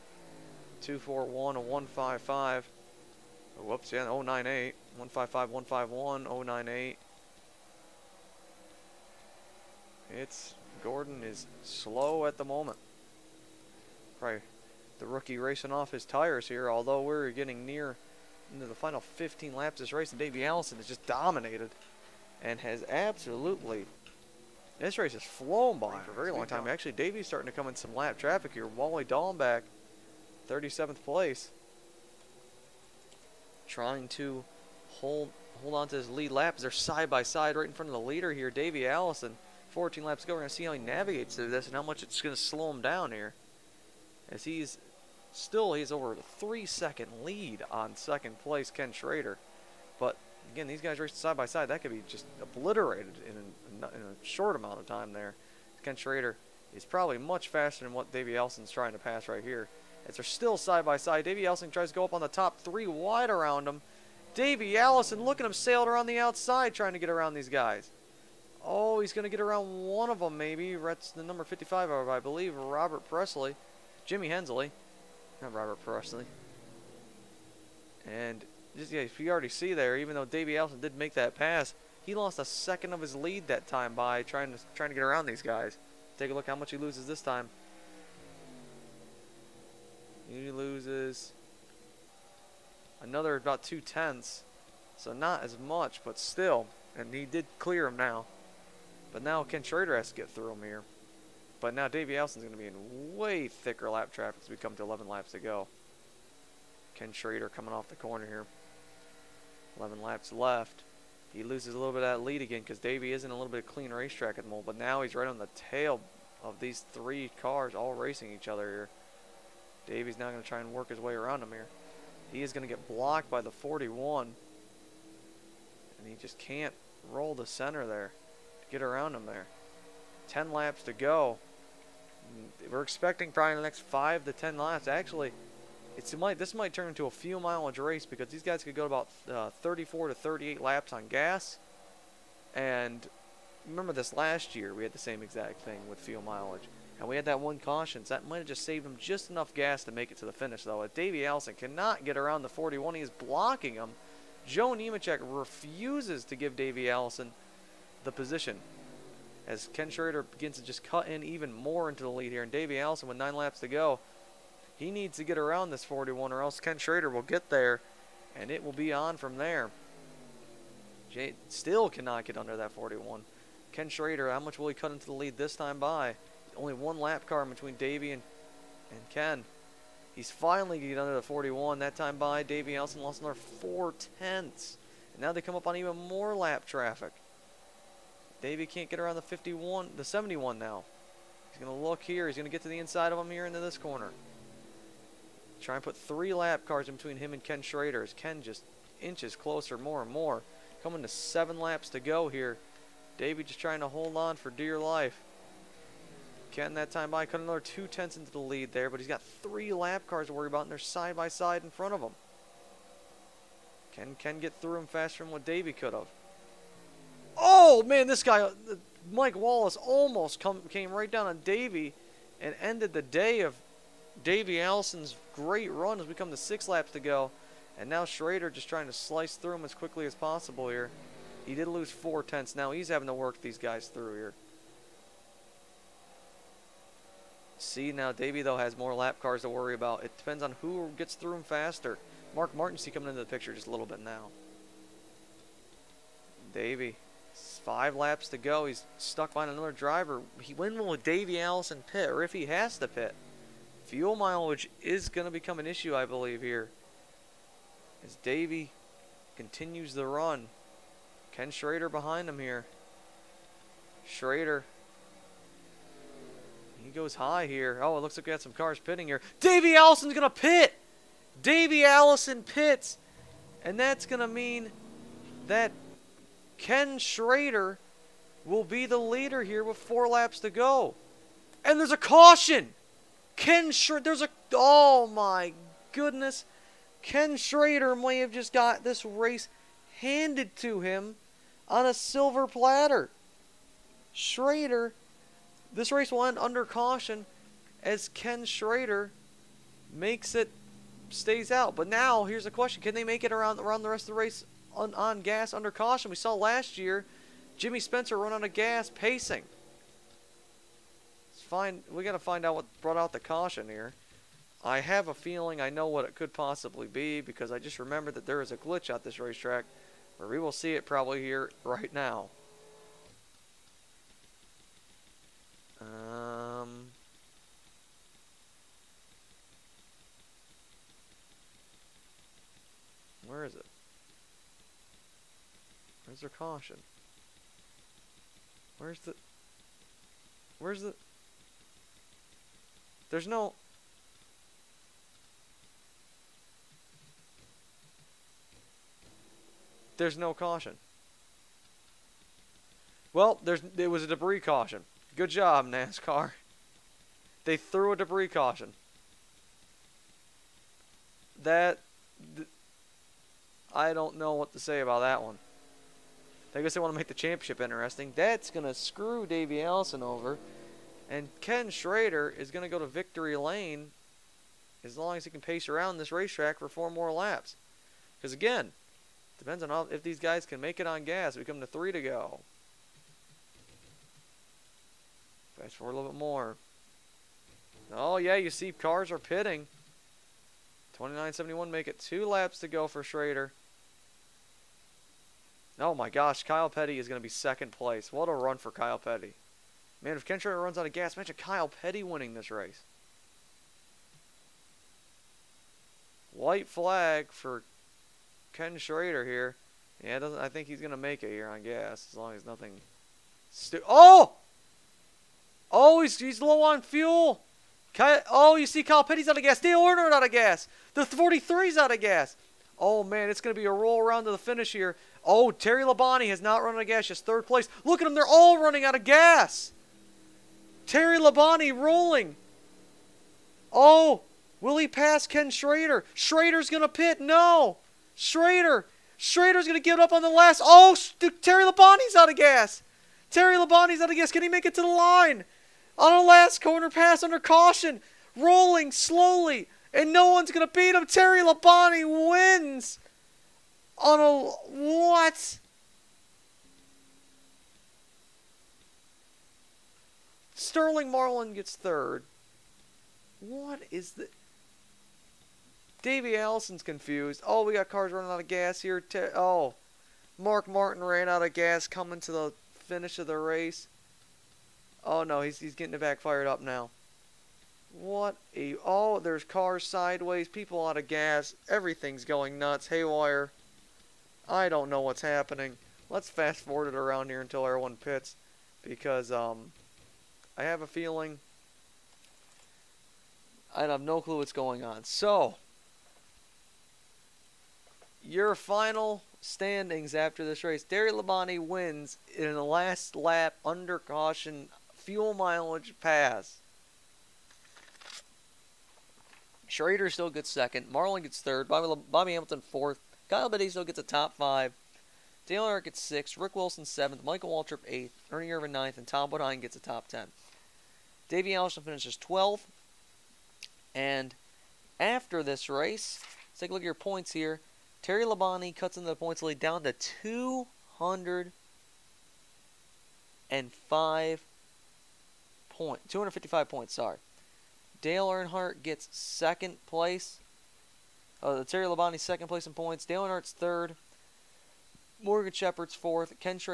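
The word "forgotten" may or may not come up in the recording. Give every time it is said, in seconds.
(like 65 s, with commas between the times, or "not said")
not said.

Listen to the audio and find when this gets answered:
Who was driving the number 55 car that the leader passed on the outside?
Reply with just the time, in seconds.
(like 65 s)
74 s.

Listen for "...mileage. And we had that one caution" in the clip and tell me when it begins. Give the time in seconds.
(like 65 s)
146 s.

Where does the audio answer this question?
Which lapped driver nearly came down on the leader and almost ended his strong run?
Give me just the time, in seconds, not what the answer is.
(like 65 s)
219 s.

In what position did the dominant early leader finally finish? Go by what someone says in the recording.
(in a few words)
12th.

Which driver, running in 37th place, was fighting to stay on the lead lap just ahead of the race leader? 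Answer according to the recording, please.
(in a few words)
Wally Dallenbach.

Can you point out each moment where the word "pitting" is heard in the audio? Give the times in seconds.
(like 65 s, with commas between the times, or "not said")
268 s, 389 s.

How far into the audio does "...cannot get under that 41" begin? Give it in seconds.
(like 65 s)
171 s.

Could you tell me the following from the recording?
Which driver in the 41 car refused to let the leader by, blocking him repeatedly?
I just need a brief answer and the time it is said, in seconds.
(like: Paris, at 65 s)
Joe Nemechek, at 154 s.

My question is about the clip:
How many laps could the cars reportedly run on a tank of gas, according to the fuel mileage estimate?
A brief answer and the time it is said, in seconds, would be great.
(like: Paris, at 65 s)
34 to 38, at 139 s.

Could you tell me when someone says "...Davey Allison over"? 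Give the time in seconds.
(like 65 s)
369 s.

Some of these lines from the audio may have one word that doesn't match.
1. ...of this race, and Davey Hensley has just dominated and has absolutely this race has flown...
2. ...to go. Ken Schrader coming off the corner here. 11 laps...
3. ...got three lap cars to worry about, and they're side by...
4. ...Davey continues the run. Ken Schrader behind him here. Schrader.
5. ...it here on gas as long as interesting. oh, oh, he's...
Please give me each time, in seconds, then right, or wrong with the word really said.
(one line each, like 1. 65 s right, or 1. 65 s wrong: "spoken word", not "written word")
1. 19 s wrong: "Allison", not "Hensley"
2. 105 s right
3. 209 s right
4. 258 s right
5. 411 s wrong: "nothing", not "interesting".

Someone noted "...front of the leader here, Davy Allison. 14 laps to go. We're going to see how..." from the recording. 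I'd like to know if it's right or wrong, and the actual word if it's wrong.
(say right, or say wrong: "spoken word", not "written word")
right.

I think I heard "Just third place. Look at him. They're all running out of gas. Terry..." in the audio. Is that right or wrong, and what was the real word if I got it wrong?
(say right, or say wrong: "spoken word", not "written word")
right.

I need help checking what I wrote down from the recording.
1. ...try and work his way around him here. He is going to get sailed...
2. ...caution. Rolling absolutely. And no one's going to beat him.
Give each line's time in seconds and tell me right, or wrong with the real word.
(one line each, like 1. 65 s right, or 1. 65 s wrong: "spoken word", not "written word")
1. 120 s wrong: "blocked", not "sailed"
2. 447 s wrong: "slowly", not "absolutely".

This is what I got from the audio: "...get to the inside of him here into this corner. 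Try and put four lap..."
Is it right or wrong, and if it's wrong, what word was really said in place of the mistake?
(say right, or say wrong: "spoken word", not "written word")
wrong: "three", not "four".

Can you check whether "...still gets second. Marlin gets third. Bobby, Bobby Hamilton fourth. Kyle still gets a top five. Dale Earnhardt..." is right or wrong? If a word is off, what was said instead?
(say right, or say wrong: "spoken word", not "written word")
right.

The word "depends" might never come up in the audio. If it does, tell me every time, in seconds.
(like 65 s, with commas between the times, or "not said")
240 s, 379 s.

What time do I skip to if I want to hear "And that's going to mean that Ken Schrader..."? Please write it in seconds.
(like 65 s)
273 s.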